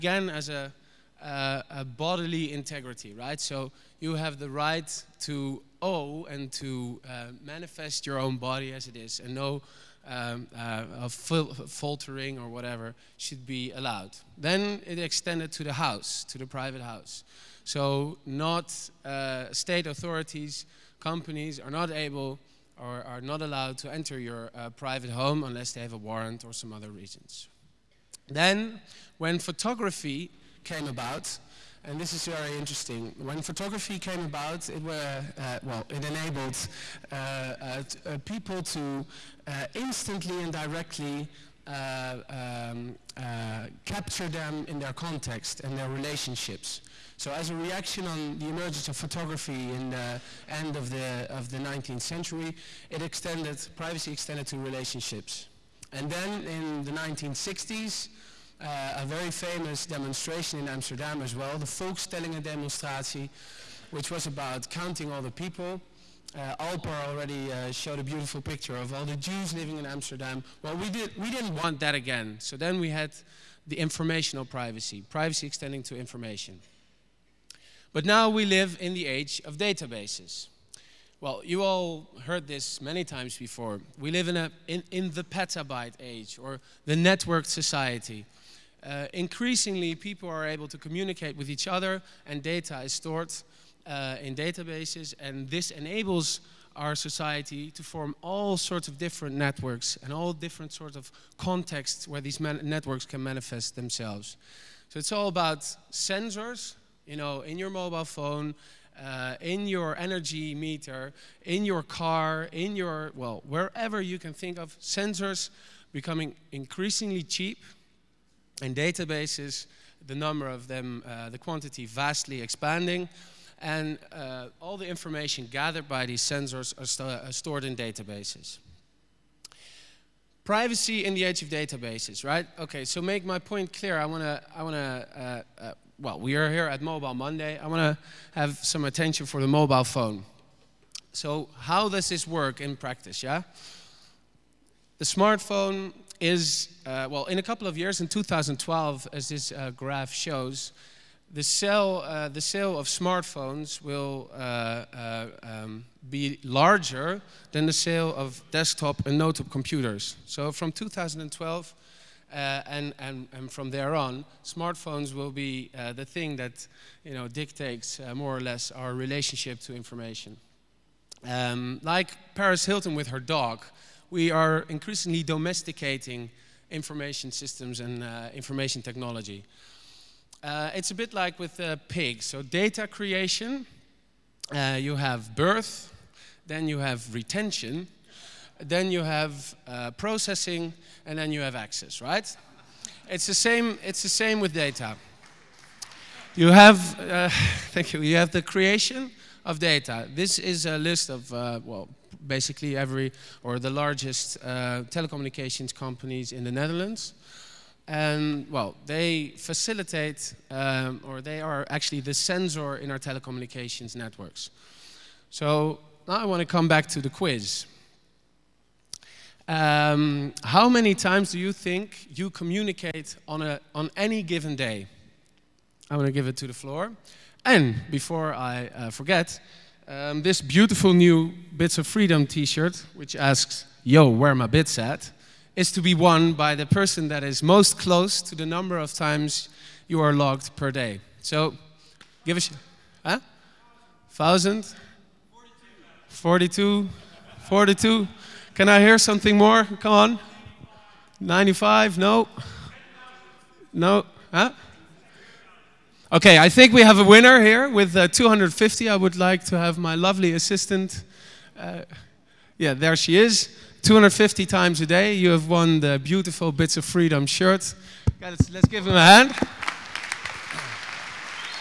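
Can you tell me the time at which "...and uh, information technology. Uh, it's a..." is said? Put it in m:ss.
2:57.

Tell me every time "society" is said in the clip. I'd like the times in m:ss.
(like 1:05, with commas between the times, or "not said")
1:27, 1:36.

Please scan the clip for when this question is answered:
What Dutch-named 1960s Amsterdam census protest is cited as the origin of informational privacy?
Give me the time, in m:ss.
1:01.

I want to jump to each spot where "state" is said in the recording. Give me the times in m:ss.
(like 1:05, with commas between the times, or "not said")
0:19.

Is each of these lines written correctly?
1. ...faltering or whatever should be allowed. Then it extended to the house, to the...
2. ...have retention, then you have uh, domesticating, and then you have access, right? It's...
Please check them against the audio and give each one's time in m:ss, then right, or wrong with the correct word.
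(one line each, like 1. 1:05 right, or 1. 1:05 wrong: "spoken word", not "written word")
1. 0:11 right
2. 3:06 wrong: "processing", not "domesticating".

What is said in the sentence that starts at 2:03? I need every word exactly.
And uh, all the information gathered by these sensors are, st are stored in databases.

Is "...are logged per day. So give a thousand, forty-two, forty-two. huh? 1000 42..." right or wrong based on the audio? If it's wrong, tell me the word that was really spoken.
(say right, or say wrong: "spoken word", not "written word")
right.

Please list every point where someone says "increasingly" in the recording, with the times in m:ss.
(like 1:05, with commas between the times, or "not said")
1:29, 1:56, 2:54.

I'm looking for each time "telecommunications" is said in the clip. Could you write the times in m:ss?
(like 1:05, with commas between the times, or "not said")
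3:24, 3:32.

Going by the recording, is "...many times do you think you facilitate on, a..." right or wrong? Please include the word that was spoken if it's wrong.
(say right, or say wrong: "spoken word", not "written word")
wrong: "communicate", not "facilitate".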